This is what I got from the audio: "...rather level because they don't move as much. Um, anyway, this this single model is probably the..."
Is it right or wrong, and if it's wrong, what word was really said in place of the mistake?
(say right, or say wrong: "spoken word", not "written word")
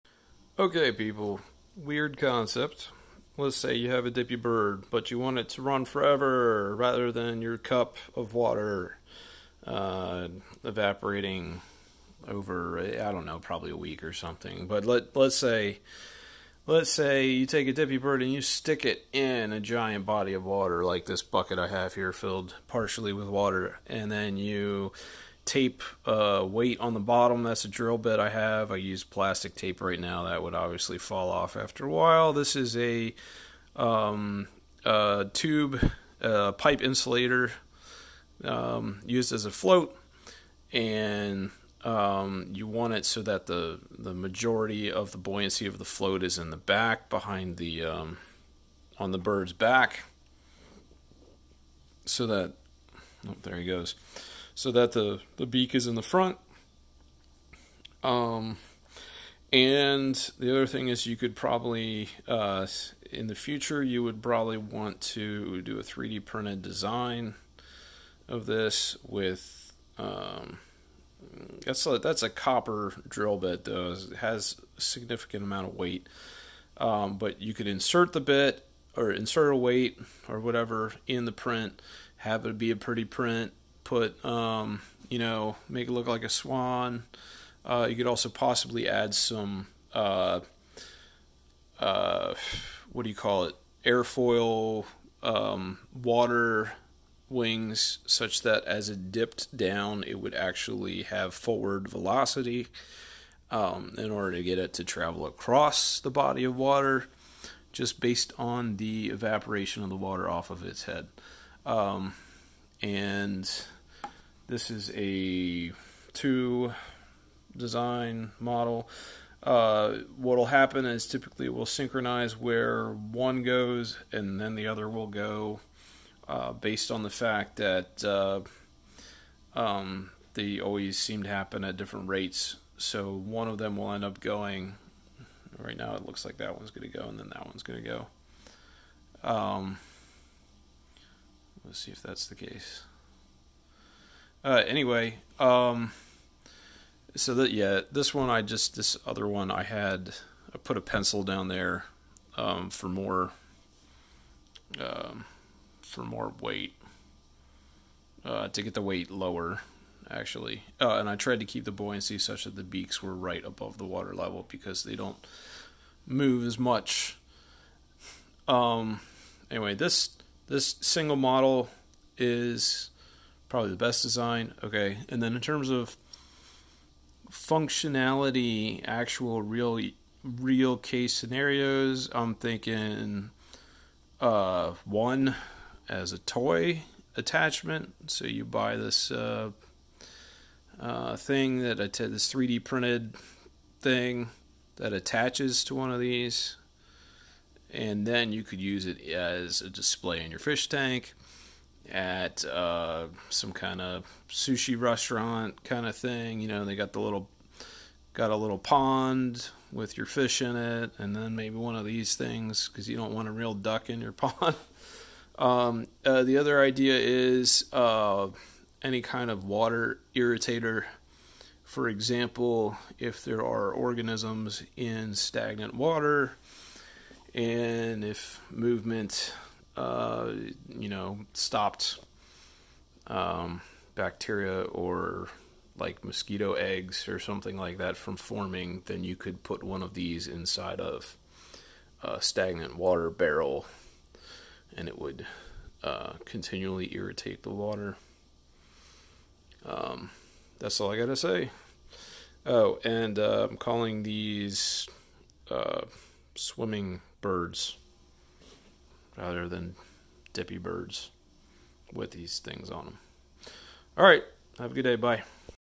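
wrong: "water", not "rather".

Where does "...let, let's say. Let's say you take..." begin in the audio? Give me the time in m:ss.
0:14.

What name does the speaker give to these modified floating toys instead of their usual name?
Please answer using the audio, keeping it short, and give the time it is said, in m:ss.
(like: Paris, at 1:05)
swimming birds, at 4:16.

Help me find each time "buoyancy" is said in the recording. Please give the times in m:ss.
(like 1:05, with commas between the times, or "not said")
0:45, 2:41.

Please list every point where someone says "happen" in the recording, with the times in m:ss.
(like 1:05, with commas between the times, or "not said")
2:00, 2:11.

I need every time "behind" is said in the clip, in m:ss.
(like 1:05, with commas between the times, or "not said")
0:47.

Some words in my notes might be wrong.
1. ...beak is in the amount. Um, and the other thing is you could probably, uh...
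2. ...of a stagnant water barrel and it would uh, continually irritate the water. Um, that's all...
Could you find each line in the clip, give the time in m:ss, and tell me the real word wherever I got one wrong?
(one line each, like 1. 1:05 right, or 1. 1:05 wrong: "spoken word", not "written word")
1. 0:55 wrong: "front", not "amount"
2. 4:00 right.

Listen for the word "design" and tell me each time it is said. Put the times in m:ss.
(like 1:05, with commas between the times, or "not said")
1:06, 1:57, 2:54.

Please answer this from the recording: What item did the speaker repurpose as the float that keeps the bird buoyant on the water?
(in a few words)
pipe insulator.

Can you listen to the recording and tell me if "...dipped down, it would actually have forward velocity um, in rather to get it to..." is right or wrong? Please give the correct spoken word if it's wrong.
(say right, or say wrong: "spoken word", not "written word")
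wrong: "order", not "rather".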